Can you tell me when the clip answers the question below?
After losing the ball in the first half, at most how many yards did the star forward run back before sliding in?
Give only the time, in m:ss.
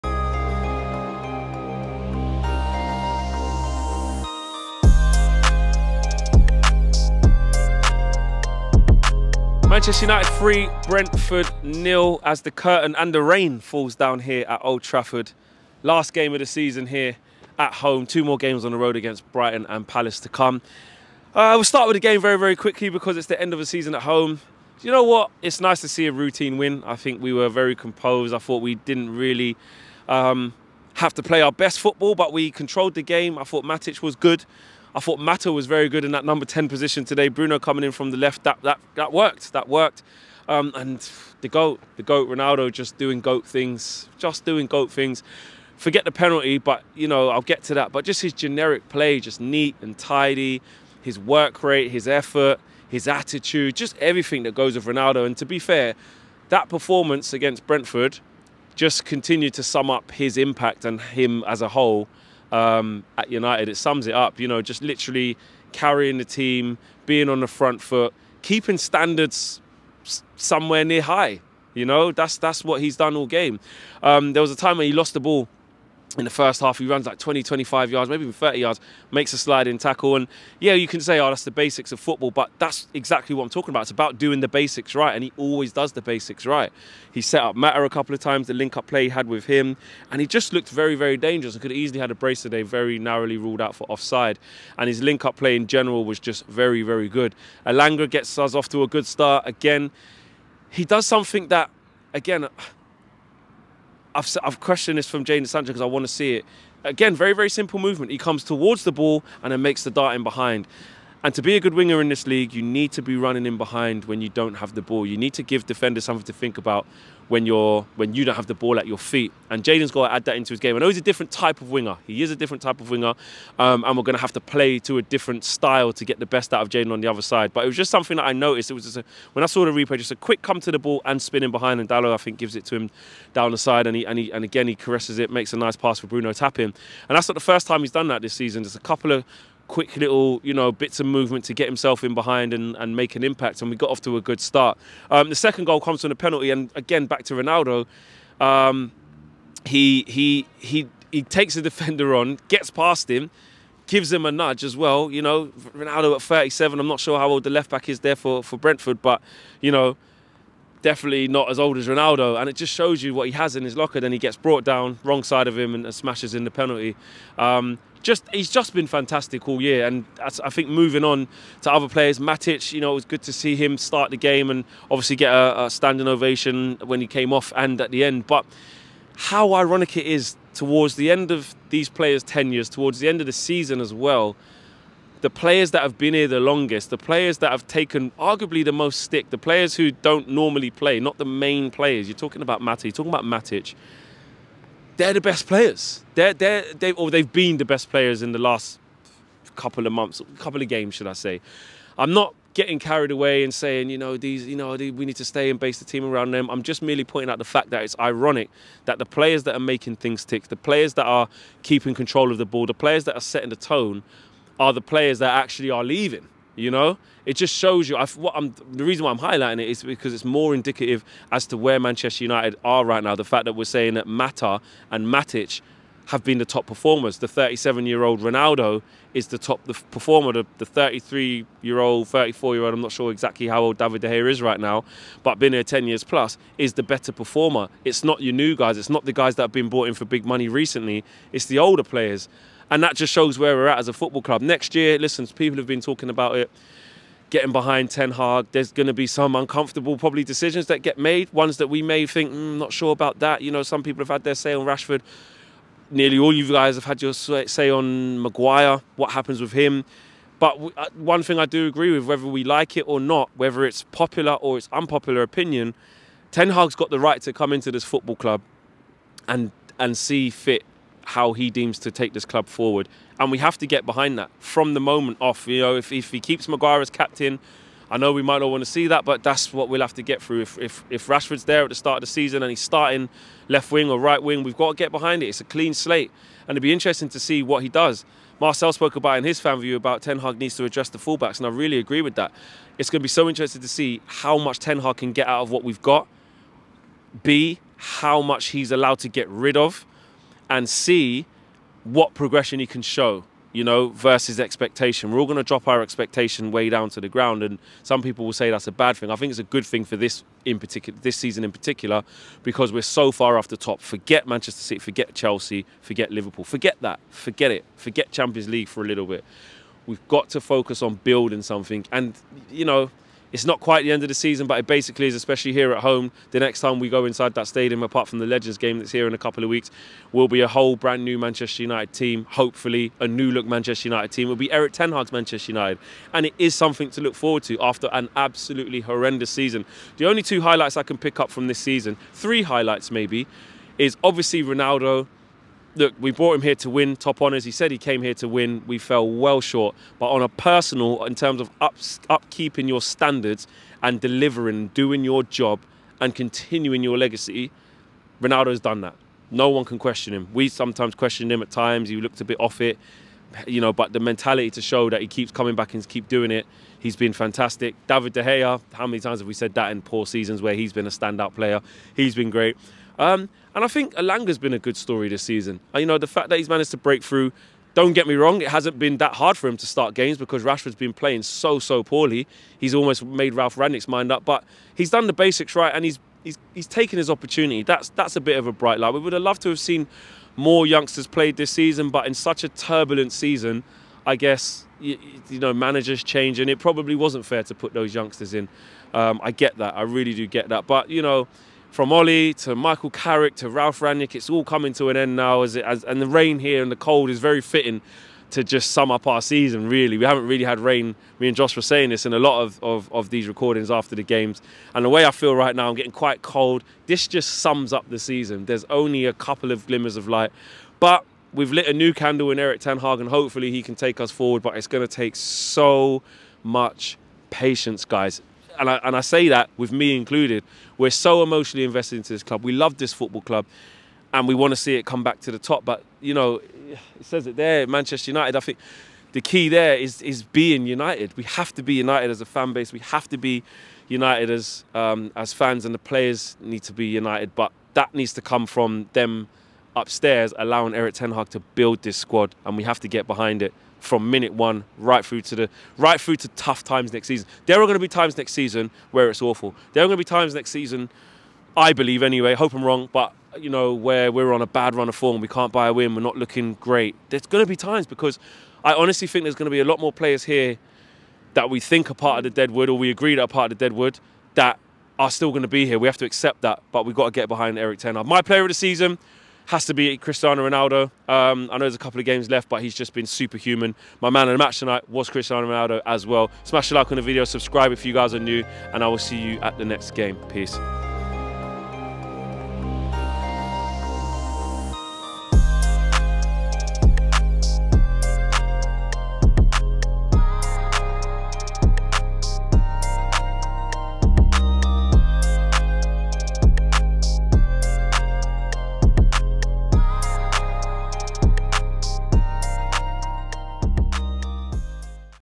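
1:18.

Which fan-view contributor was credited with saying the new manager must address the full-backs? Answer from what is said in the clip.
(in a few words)
Marcel.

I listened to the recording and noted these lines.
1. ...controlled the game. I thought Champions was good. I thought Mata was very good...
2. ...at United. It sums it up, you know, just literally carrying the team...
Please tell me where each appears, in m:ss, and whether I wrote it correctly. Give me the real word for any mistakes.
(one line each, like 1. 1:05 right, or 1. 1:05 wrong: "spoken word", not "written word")
1. 0:32 wrong: "Matic", not "Champions"
2. 1:03 right.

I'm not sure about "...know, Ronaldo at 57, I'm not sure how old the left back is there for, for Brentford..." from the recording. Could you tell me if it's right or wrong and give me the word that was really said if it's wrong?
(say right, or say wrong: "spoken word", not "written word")
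wrong: "37", not "57".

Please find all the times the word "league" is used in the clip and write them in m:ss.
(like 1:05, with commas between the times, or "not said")
1:52, 5:18.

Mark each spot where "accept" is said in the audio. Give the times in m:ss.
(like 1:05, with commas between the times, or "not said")
7:56.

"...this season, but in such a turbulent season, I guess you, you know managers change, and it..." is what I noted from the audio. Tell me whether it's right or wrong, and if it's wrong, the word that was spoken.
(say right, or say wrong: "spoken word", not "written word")
right.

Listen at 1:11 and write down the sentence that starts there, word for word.
You know, that's that's what he's done all game.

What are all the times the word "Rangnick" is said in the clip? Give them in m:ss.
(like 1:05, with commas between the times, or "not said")
6:23, 6:43.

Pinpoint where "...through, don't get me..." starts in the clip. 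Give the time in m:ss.
6:17.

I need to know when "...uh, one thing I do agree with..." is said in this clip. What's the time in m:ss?
4:20.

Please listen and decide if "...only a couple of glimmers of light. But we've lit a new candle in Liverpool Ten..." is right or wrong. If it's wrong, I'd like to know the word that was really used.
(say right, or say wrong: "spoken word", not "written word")
wrong: "Erik", not "Liverpool".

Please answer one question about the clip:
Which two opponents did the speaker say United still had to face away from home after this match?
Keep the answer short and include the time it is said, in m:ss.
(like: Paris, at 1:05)
Brighton and Palace, at 0:19.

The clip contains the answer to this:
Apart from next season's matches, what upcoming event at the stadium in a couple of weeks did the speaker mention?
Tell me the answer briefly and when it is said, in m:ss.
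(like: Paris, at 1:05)
Legends game, at 5:28.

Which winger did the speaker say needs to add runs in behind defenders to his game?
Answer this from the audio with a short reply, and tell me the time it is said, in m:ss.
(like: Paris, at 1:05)
Jaden Sancho, at 1:45.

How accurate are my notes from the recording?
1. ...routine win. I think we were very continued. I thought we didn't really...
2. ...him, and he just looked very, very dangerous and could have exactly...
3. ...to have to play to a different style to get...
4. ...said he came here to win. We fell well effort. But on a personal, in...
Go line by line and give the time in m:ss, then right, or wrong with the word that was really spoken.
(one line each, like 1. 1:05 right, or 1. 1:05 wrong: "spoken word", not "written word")
1. 0:26 wrong: "composed", not "continued"
2. 1:29 wrong: "easily", not "exactly"
3. 2:04 right
4. 5:47 wrong: "short", not "effort".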